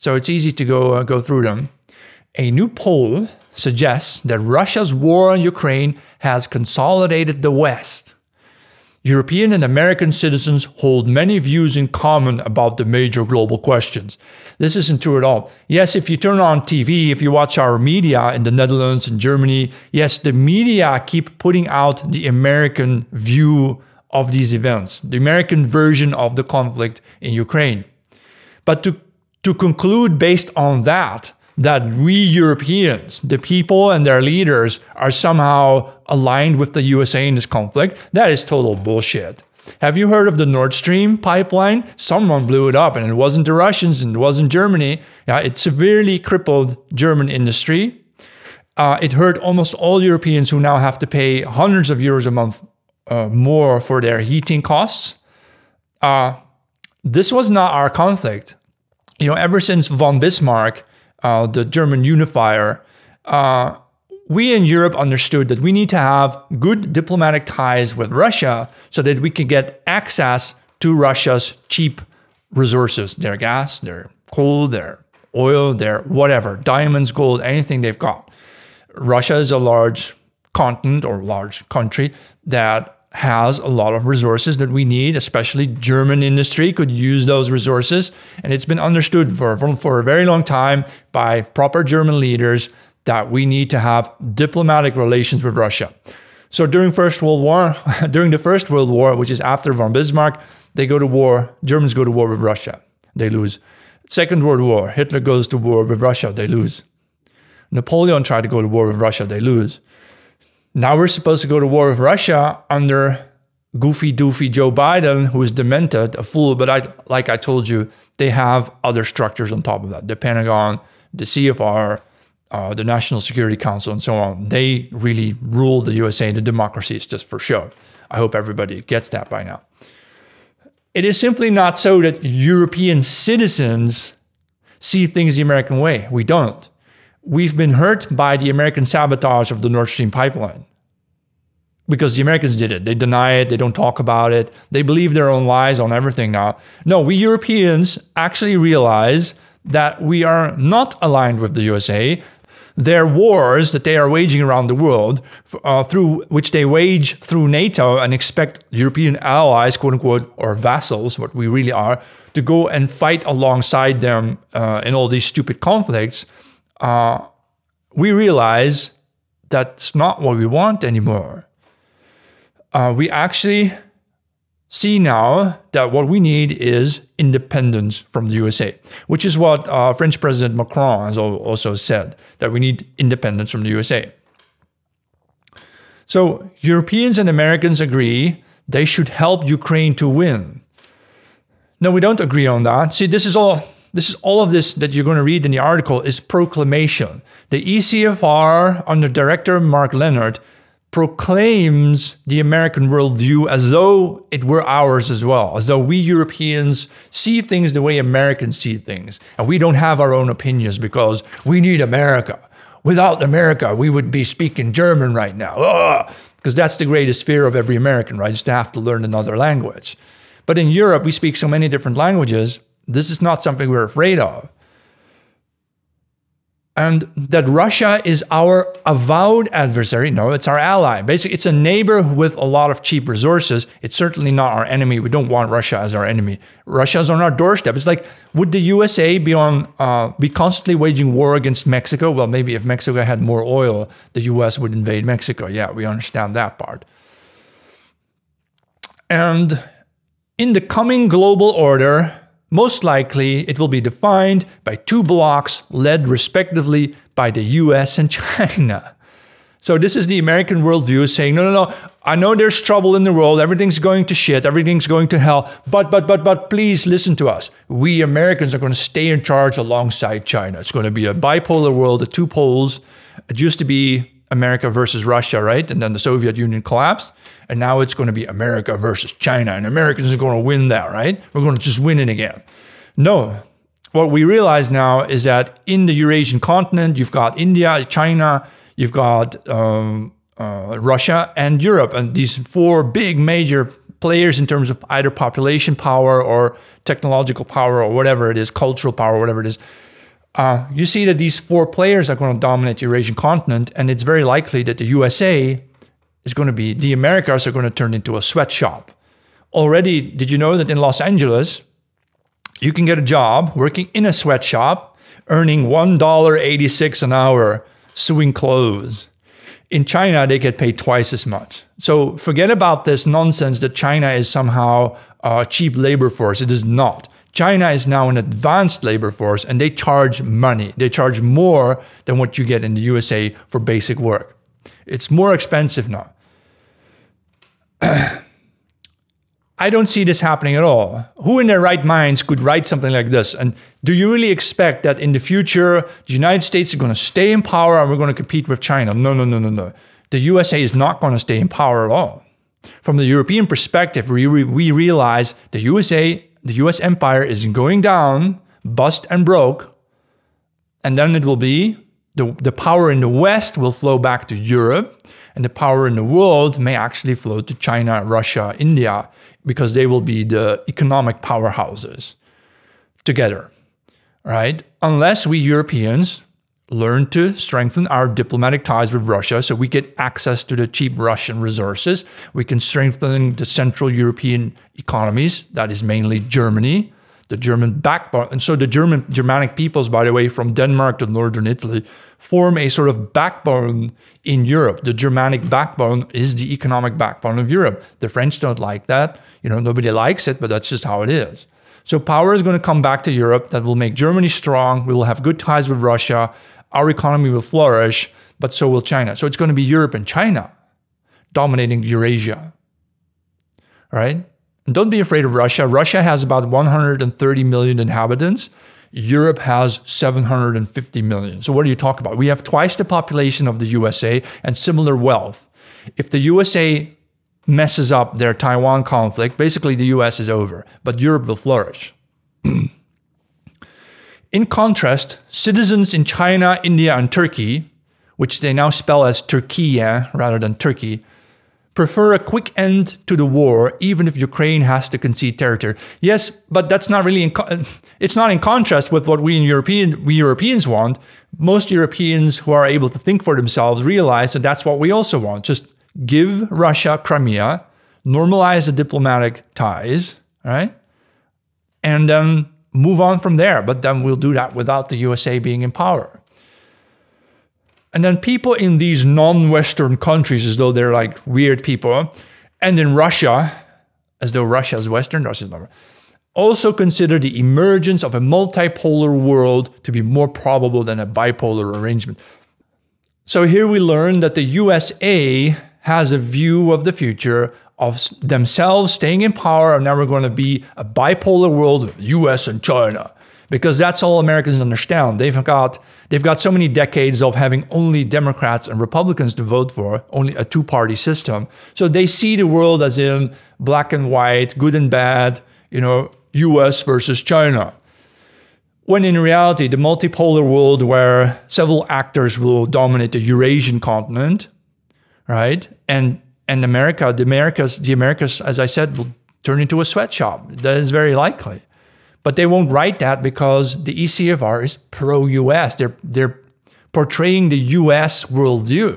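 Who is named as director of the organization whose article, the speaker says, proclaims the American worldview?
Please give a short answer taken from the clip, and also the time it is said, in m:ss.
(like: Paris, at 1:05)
Mark Leonard, at 3:19.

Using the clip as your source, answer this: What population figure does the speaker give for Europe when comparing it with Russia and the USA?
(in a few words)
750 million.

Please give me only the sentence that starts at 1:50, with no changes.
Now we're supposed to go to war with Russia under goofy doofy Joe Biden, who is demented, a fool.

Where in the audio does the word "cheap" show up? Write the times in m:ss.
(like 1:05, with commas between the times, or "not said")
1:11, 3:52, 5:25, 6:20.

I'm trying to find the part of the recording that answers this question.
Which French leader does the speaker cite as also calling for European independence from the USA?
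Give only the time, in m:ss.
3:00.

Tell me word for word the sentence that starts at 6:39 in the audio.
You know, nobody likes it, but that's just how it is.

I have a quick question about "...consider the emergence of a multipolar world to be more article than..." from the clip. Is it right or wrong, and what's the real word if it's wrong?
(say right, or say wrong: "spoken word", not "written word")
wrong: "probable", not "article".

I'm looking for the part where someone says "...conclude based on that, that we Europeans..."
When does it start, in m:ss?
0:29.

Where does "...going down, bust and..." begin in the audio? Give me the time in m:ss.
5:57.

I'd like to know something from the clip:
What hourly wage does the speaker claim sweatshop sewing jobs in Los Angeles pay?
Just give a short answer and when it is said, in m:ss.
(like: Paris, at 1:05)
$1.86, at 5:15.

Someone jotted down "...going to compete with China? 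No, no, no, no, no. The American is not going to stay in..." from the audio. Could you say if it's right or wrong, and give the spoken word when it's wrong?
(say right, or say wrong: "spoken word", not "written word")
wrong: "USA", not "American".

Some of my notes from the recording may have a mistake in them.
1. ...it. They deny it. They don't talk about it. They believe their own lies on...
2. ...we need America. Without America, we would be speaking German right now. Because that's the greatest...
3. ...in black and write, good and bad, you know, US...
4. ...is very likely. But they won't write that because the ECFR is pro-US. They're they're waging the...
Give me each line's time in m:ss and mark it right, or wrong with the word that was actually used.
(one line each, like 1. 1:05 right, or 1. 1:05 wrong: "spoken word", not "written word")
1. 2:22 right
2. 3:31 right
3. 8:22 wrong: "white", not "write"
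4. 8:40 wrong: "portraying", not "waging".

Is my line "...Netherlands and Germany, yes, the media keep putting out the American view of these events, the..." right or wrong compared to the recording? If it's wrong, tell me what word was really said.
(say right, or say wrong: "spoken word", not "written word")
right.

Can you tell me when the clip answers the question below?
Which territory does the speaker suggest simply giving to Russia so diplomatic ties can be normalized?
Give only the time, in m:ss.
7:37.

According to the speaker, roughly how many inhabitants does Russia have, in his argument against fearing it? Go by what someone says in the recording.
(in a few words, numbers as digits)
130 million.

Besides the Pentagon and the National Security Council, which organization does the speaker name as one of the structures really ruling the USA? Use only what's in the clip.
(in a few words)
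CFR.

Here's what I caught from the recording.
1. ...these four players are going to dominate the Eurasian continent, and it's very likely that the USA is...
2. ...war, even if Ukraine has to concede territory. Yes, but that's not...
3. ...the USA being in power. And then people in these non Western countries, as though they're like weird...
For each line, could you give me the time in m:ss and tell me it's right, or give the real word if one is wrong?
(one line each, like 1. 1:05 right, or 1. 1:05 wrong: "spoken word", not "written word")
1. 5:01 right
2. 7:23 right
3. 7:44 right.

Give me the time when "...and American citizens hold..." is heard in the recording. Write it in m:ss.
0:09.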